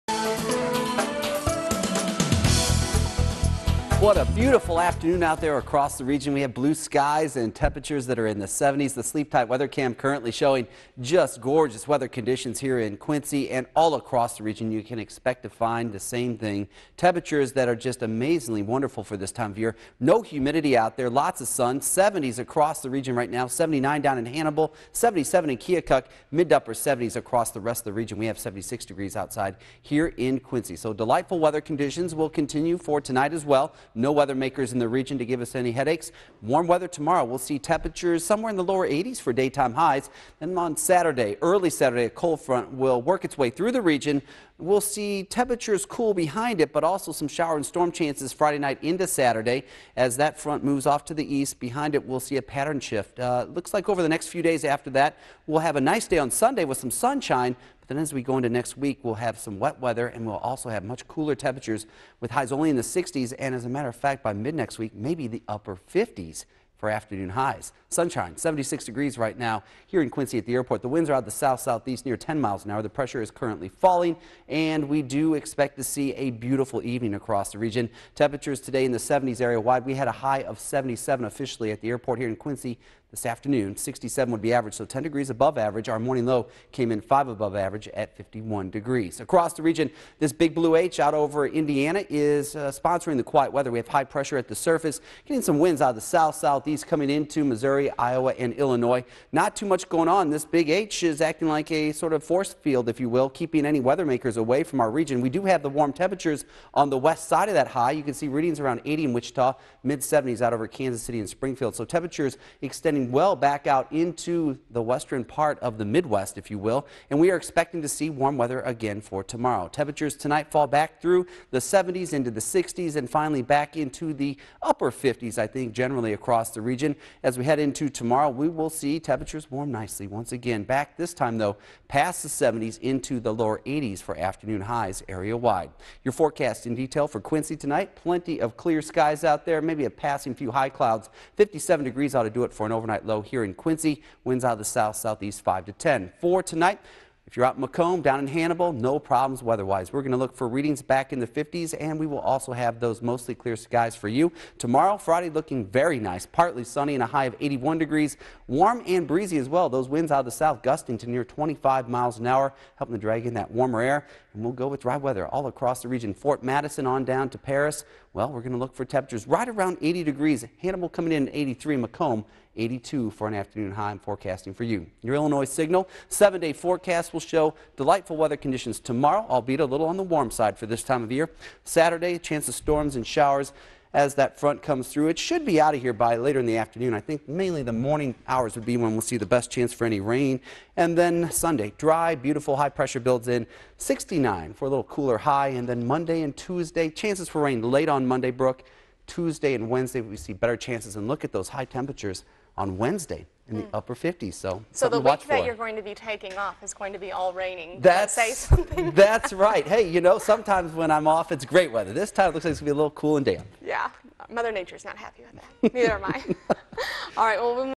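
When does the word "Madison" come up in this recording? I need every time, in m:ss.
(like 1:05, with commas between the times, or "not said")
2:46.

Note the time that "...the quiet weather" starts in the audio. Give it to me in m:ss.
1:33.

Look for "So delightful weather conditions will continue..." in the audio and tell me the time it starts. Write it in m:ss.
0:30.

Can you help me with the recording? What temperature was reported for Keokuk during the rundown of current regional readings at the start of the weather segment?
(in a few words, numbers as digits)
77.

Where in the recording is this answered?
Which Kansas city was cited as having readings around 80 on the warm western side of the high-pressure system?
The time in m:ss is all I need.
1:49.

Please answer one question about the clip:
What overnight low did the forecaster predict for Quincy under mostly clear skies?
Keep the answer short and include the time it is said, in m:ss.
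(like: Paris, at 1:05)
57 degrees, at 2:21.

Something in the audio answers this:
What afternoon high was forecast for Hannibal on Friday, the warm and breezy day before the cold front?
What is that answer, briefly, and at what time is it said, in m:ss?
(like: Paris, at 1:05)
83, at 2:50.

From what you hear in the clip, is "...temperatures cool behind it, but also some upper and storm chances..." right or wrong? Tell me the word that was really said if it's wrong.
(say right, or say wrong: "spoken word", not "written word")
wrong: "shower", not "upper".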